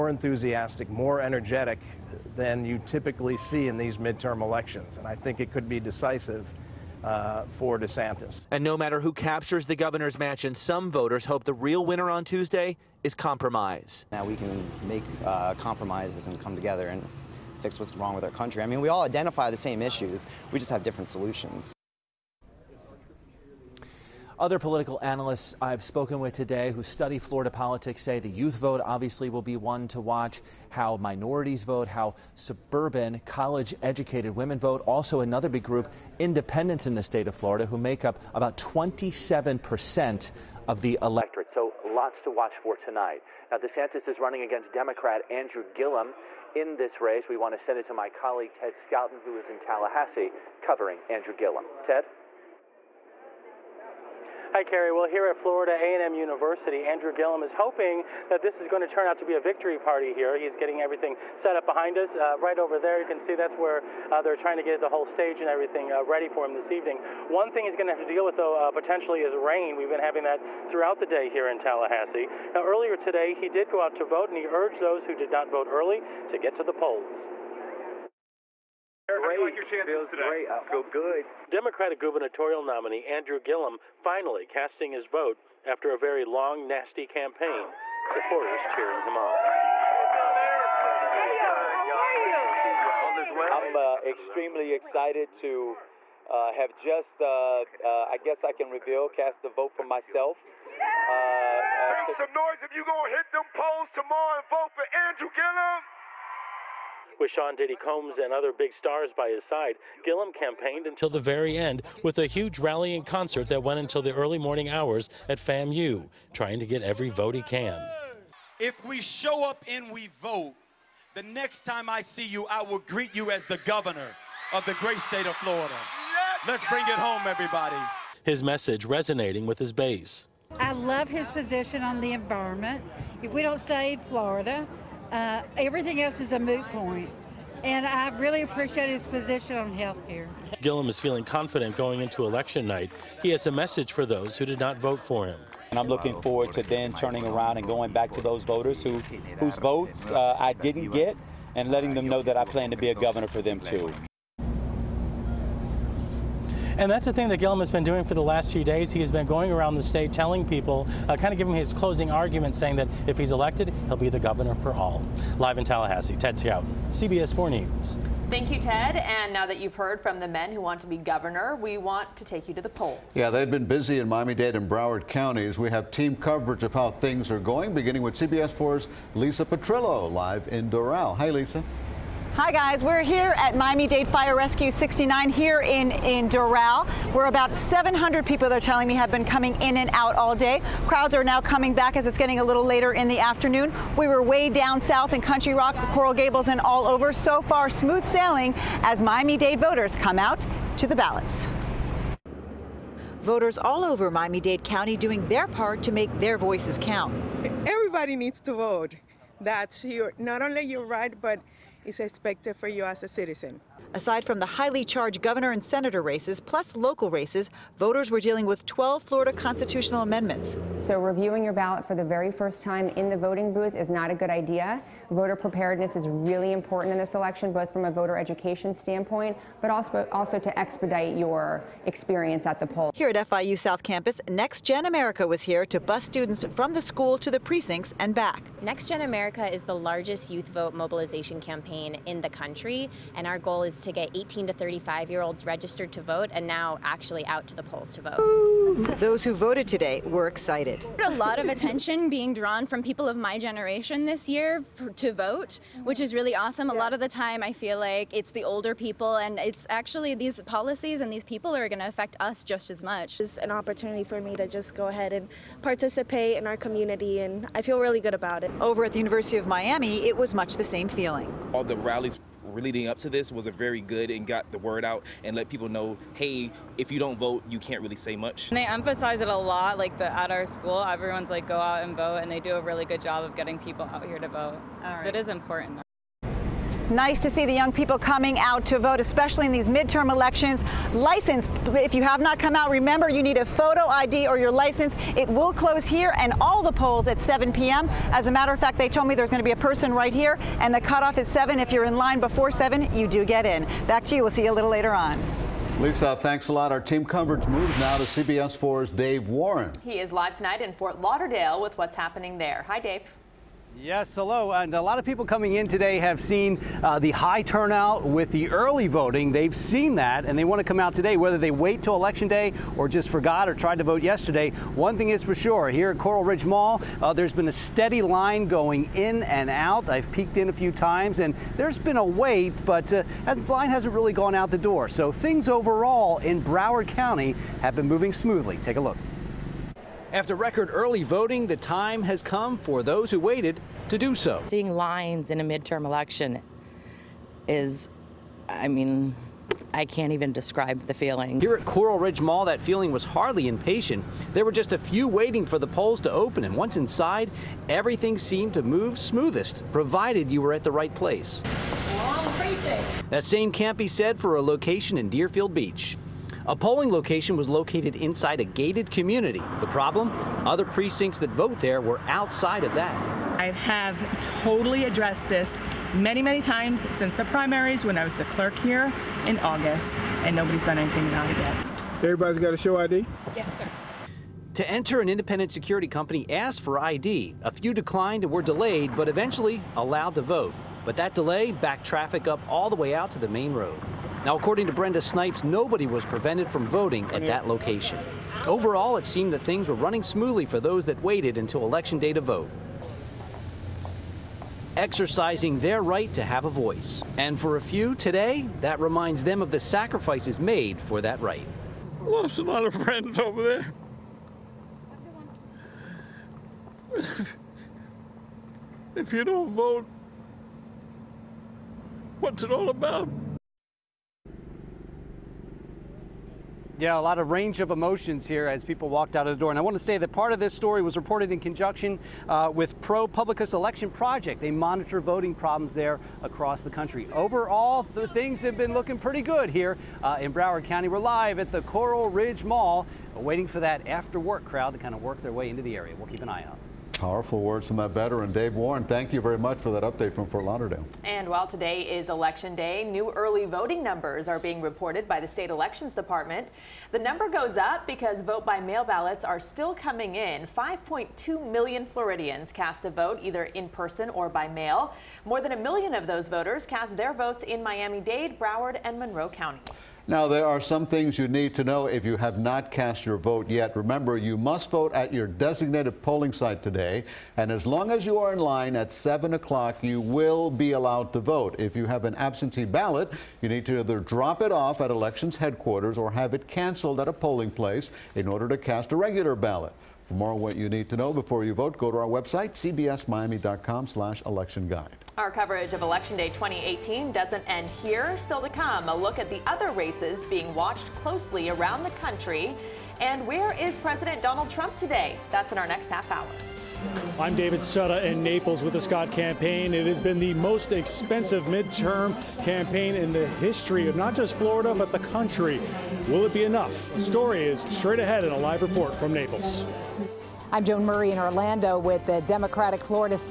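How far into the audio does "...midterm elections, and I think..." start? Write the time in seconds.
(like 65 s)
3 s.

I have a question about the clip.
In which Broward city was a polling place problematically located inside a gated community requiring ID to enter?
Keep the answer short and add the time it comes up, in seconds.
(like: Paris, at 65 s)
Deerfield Beach, at 365 s.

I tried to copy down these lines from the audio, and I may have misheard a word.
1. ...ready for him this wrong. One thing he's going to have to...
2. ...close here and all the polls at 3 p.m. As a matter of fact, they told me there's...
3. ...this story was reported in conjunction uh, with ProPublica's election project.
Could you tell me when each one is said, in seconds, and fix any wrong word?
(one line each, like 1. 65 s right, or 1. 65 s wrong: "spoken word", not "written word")
1. 66 s wrong: "evening", not "wrong"
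2. 295 s wrong: "7", not "3"
3. 430 s right.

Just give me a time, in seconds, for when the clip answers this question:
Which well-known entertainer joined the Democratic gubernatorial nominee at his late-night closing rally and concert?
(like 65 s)
107 s.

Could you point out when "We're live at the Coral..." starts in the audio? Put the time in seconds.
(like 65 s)
440 s.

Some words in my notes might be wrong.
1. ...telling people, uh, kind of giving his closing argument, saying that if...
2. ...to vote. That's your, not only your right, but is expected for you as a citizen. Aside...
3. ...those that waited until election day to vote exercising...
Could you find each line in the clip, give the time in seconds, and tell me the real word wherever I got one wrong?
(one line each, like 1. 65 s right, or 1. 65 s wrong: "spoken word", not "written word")
1. 160 s right
2. 208 s right
3. 400 s right.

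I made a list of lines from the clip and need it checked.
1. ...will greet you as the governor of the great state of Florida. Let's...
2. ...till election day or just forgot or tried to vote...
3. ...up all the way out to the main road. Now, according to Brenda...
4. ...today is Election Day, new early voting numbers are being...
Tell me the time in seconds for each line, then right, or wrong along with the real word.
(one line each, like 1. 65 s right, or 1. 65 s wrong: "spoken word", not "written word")
1. 122 s right
2. 321 s right
3. 392 s right
4. 451 s right.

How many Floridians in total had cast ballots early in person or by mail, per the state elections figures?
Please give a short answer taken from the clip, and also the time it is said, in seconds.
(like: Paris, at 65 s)
5.2 million, at 460 s.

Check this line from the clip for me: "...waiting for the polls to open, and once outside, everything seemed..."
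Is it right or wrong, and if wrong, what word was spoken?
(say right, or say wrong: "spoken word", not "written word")
wrong: "inside", not "outside".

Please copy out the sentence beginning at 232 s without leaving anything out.
Here at FIU South Campus, Next Gen America was here to bus students from the school to the precincts and back.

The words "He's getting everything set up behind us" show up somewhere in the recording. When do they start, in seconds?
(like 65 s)
60 s.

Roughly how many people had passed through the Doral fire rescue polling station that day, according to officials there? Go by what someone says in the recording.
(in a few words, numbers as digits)
700.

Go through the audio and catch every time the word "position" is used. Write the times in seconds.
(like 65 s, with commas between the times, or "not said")
131 s, 139 s.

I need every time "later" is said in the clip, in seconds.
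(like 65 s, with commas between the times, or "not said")
192 s, 304 s.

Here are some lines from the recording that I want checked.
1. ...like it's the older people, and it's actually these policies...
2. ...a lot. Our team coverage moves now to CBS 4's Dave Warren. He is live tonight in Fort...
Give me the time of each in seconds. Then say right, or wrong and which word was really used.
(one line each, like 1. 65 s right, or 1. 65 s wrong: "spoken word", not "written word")
1. 257 s right
2. 306 s right.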